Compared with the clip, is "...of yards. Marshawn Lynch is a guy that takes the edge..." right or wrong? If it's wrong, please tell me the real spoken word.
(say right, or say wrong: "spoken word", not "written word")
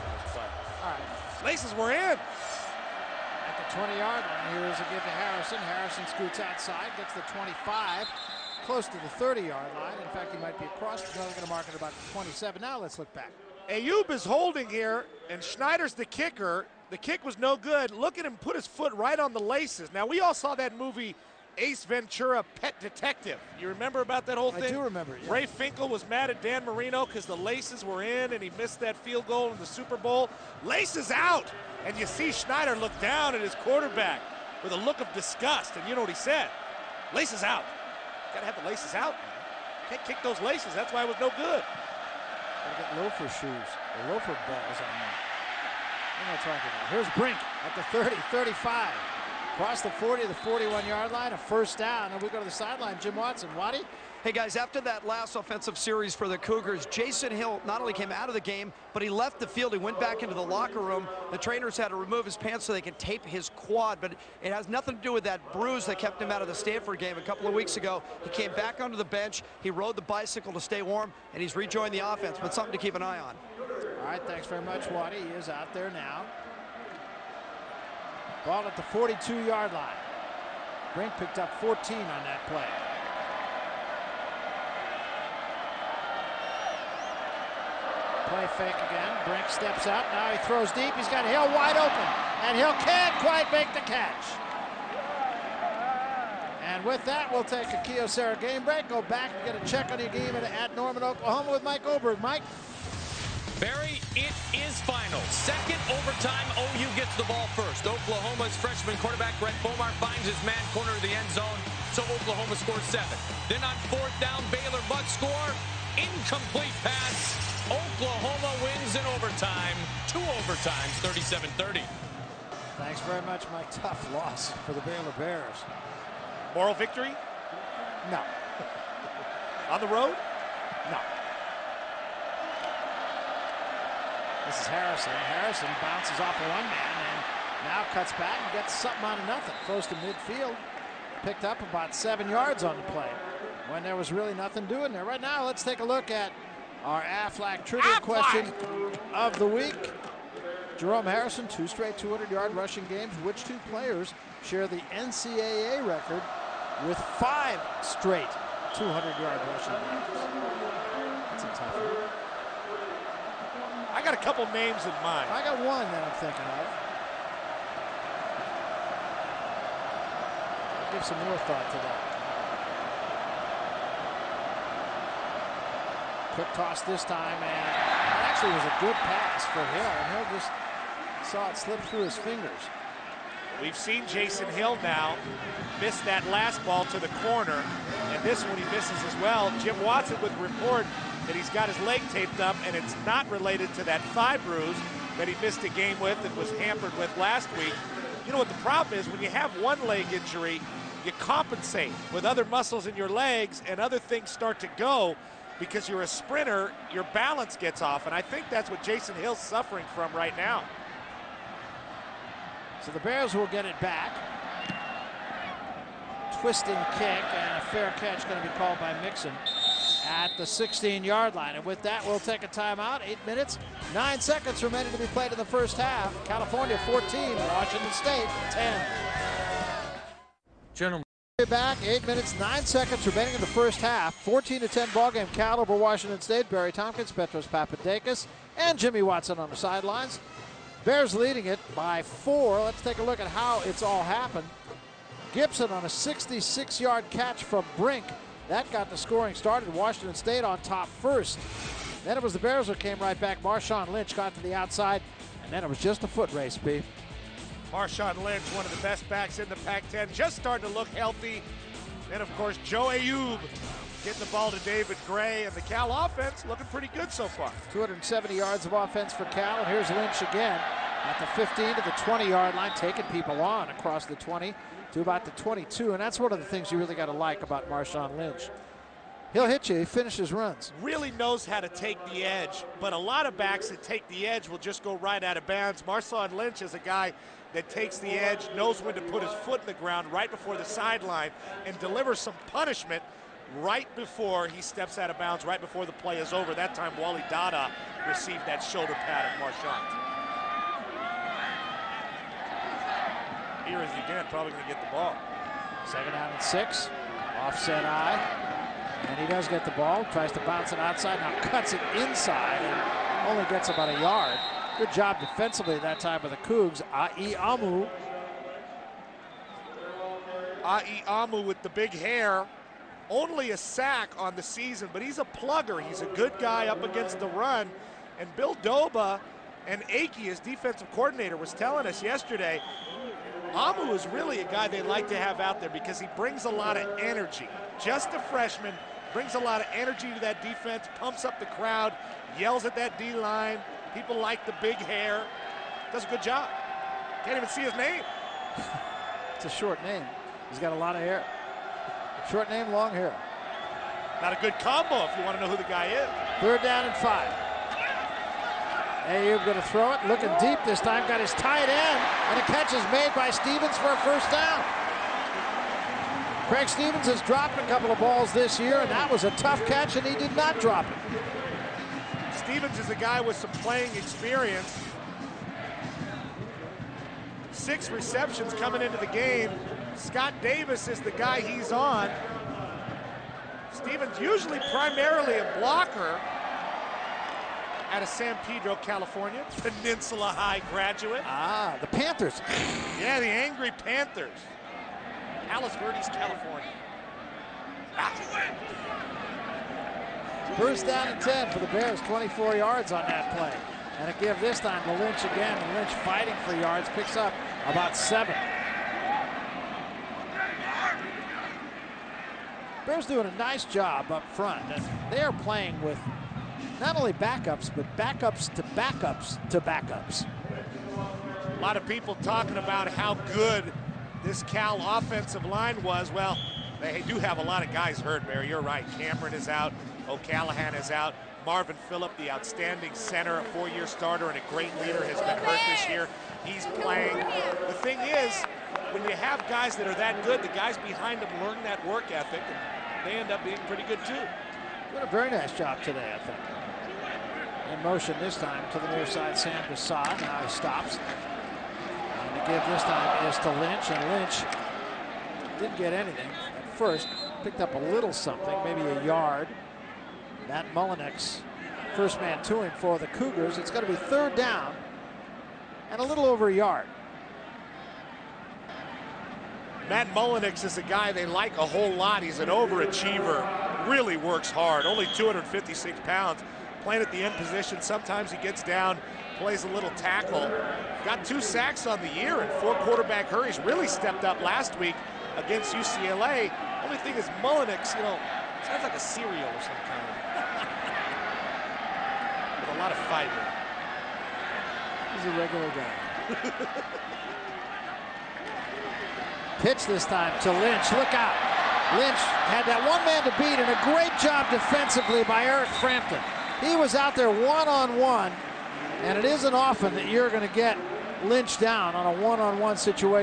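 wrong: "bounds", not "yards".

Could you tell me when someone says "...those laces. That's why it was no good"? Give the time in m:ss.
0:40.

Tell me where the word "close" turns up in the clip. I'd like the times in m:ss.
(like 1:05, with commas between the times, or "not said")
0:08, 2:19.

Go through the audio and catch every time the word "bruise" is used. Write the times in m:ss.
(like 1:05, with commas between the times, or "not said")
1:05, 3:14.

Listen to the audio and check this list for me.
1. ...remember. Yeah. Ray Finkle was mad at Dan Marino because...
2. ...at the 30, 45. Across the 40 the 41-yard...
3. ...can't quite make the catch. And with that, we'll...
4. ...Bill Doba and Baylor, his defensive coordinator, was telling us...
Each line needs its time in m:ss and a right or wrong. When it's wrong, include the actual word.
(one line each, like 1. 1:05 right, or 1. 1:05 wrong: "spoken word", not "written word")
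1. 0:24 right
2. 0:47 wrong: "35", not "45"
3. 1:32 right
4. 5:28 wrong: "Akey", not "Baylor".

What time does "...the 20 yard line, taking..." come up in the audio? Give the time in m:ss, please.
4:31.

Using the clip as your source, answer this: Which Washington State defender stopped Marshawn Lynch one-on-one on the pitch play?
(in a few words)
Eric Frampton.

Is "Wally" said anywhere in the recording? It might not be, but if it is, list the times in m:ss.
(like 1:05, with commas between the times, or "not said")
4:57.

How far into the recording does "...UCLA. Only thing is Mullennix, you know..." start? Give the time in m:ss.
8:05.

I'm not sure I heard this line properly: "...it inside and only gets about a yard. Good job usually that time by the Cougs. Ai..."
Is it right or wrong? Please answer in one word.
wrong.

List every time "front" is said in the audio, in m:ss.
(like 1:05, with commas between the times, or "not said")
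6:54.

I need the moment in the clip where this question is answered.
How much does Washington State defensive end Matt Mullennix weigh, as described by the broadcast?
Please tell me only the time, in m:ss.
7:55.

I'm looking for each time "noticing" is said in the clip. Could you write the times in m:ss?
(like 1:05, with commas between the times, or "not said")
not said.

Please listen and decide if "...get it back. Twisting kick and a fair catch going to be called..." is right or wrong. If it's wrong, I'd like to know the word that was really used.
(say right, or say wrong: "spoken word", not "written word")
right.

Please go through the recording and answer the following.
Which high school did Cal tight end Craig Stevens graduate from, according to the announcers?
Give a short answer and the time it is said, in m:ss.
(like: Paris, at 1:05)
Peninsula High, at 6:29.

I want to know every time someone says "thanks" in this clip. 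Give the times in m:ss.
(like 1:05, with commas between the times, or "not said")
1:14, 2:02.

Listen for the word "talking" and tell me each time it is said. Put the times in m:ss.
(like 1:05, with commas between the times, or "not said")
0:46, 7:02.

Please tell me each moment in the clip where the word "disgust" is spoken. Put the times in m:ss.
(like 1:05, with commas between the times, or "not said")
0:35.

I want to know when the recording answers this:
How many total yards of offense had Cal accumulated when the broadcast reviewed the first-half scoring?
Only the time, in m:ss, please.
4:27.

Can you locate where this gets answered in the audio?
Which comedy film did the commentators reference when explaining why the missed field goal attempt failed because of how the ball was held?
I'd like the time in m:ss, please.
0:21.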